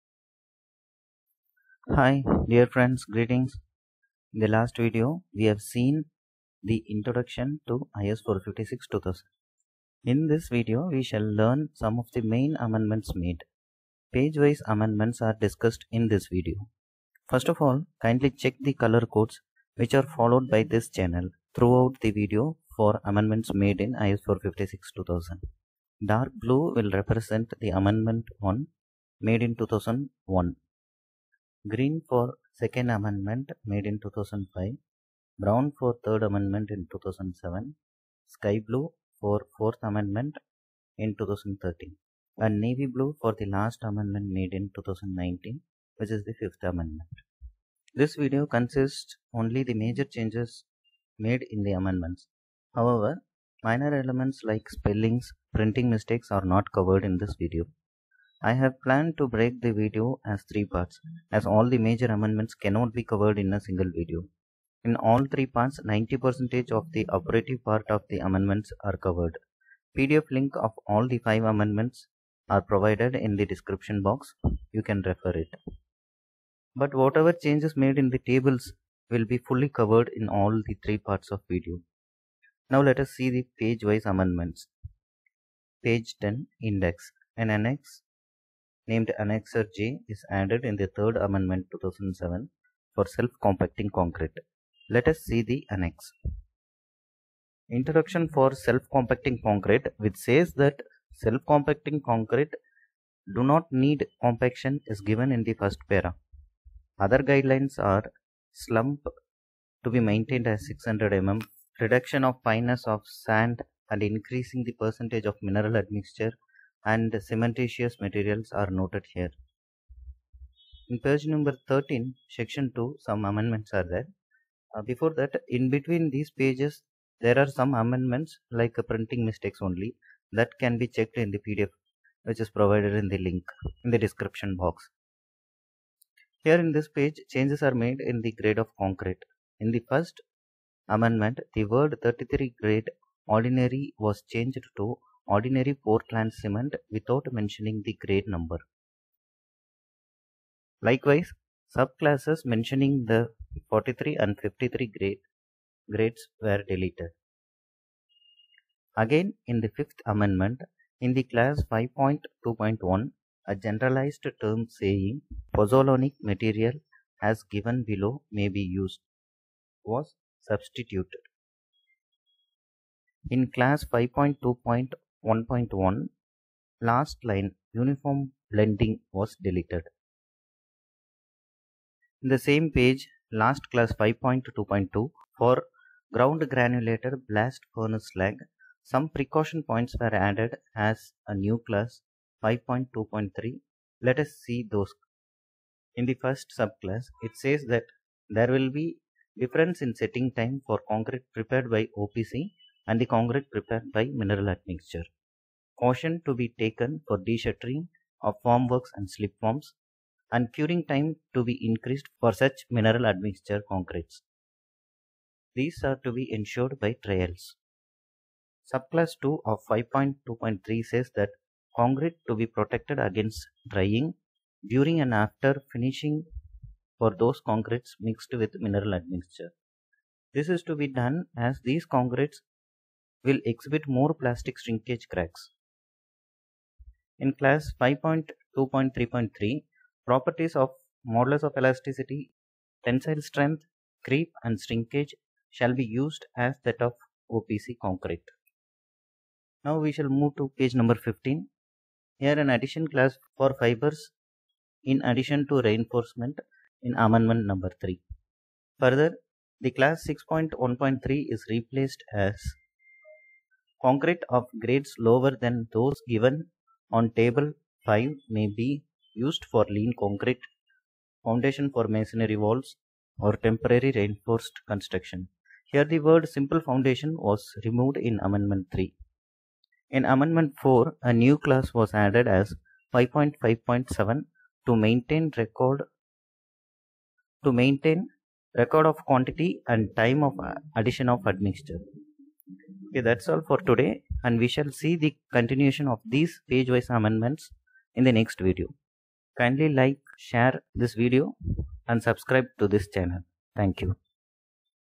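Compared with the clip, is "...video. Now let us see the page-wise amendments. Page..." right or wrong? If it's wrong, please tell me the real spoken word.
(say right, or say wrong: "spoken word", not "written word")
right.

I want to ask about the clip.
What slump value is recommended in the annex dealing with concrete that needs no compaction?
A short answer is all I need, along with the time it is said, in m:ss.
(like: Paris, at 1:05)
600 mm, at 1:50.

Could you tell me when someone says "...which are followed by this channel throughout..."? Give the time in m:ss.
0:19.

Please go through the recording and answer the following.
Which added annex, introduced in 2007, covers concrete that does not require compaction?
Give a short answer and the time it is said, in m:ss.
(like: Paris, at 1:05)
Annexure J, at 1:29.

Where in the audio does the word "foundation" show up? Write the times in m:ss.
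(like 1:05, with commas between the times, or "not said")
4:31, 4:36.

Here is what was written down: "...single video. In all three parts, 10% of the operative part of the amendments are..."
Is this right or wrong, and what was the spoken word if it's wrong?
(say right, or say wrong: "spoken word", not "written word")
wrong: "90", not "10".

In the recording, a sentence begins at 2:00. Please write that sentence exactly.
In page number 13, section 2, some amendments are there.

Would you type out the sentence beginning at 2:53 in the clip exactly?
In class 5.2.4, 1.1 last line uniform blending was deleted.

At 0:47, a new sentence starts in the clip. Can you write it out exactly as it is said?
This video consists only the major changes made in the amendments.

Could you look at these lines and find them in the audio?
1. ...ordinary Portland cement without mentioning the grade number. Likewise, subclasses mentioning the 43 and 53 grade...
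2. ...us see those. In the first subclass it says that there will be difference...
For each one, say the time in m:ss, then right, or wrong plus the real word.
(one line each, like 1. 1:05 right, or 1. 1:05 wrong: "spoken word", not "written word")
1. 2:25 right
2. 3:14 right.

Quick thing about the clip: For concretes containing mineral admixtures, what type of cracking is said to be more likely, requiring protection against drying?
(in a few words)
plastic shrinkage cracks.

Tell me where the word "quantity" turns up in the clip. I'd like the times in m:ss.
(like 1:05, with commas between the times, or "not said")
4:49.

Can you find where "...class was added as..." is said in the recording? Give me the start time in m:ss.
4:41.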